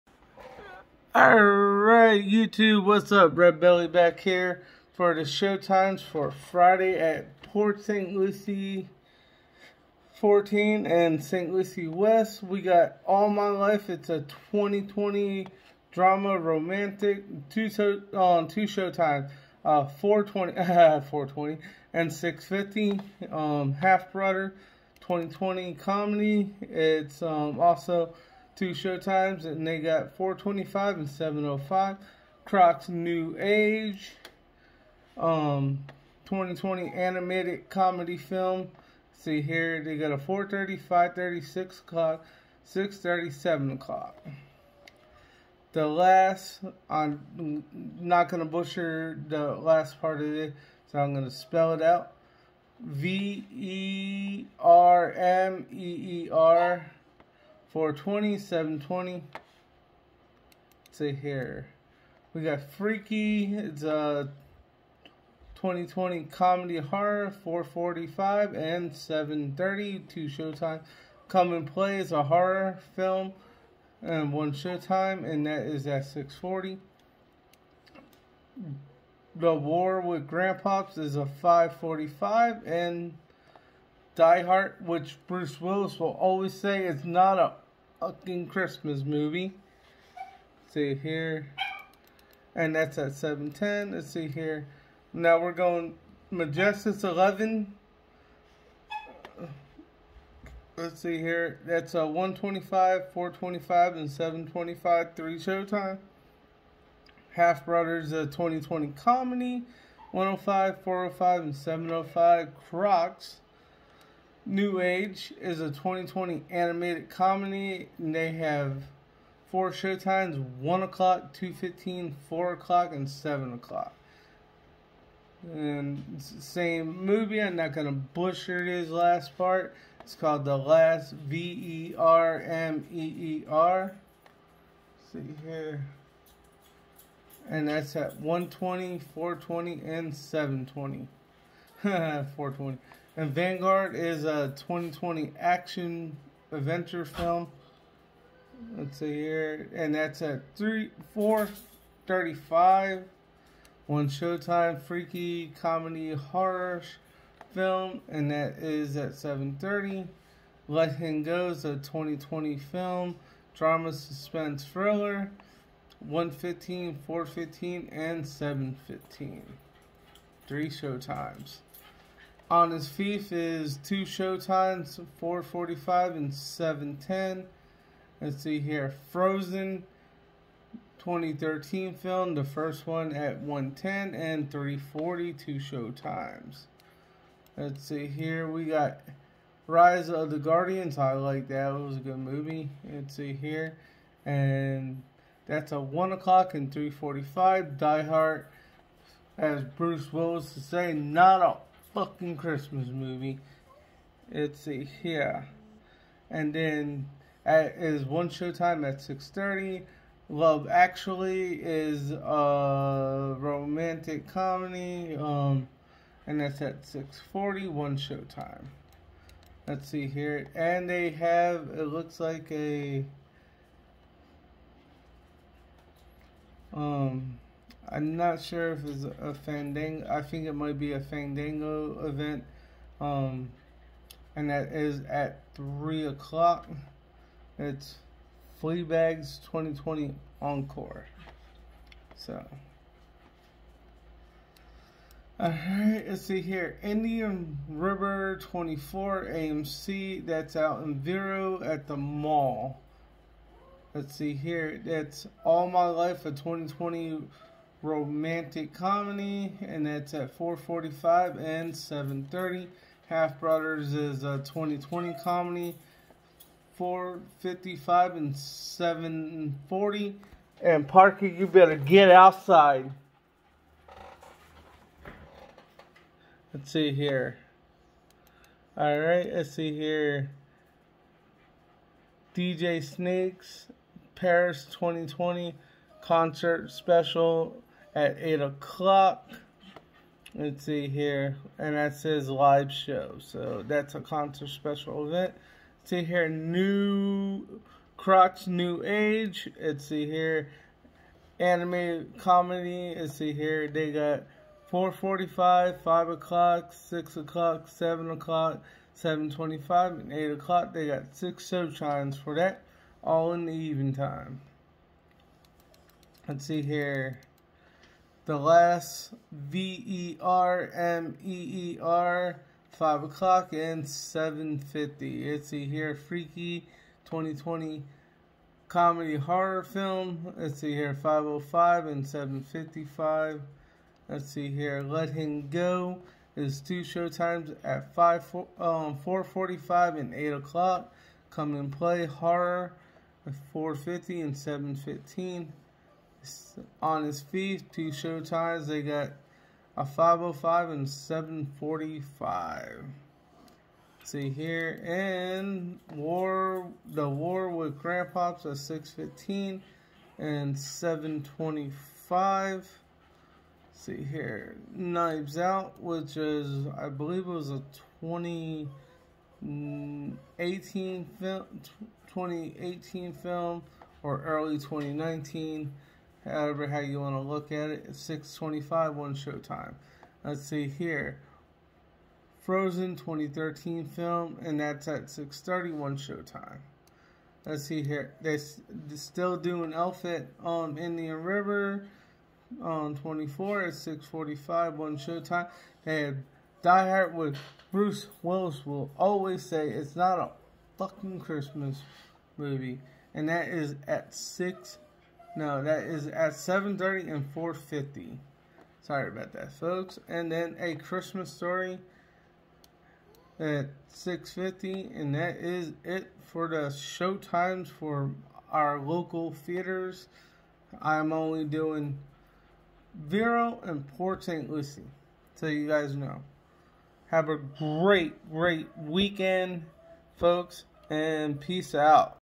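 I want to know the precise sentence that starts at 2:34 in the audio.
Freaky comedy horror film, and that is at seven thirty.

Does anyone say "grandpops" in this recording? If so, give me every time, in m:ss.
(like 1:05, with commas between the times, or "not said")
1:20, 5:57.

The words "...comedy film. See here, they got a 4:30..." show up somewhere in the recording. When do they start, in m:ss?
0:37.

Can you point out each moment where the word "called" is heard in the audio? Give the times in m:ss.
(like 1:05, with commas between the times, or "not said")
2:10.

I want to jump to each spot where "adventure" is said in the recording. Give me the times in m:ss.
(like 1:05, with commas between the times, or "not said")
2:26.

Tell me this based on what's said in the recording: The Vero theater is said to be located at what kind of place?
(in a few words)
the mall.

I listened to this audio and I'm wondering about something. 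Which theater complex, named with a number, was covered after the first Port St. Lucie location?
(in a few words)
Majestic 11.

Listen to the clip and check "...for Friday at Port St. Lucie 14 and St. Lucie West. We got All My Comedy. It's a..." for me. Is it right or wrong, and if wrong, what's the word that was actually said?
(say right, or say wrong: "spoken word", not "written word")
wrong: "Life", not "Comedy".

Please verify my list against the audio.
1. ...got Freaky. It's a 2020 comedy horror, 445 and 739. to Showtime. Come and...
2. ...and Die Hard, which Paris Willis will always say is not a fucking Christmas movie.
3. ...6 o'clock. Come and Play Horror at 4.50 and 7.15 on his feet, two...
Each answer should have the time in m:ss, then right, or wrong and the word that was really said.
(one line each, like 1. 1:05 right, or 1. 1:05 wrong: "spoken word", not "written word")
1. 1:02 wrong: "730", not "739"
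2. 1:22 wrong: "Bruce", not "Paris"
3. 5:40 wrong: "8", not "6".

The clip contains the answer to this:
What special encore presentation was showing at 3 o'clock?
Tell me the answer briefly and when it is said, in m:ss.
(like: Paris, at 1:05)
Fleabag's 2020 Encore, at 3:58.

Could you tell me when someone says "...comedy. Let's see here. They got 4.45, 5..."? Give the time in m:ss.
5:02.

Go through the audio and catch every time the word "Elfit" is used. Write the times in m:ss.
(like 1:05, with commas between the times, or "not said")
6:29.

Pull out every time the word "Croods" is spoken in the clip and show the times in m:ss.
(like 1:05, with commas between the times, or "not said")
0:32, 1:52, 4:57.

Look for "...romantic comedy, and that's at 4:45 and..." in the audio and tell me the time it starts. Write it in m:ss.
4:17.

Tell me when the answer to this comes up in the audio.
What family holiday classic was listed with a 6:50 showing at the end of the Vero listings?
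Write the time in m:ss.
6:50.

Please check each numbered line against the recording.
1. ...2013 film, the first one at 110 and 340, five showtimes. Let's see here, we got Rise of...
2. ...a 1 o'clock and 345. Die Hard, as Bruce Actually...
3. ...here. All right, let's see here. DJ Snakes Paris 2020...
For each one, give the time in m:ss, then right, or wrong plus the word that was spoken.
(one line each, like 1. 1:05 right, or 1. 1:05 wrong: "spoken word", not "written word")
1. 3:00 wrong: "two", not "five"
2. 3:15 wrong: "Willis", not "Actually"
3. 4:36 right.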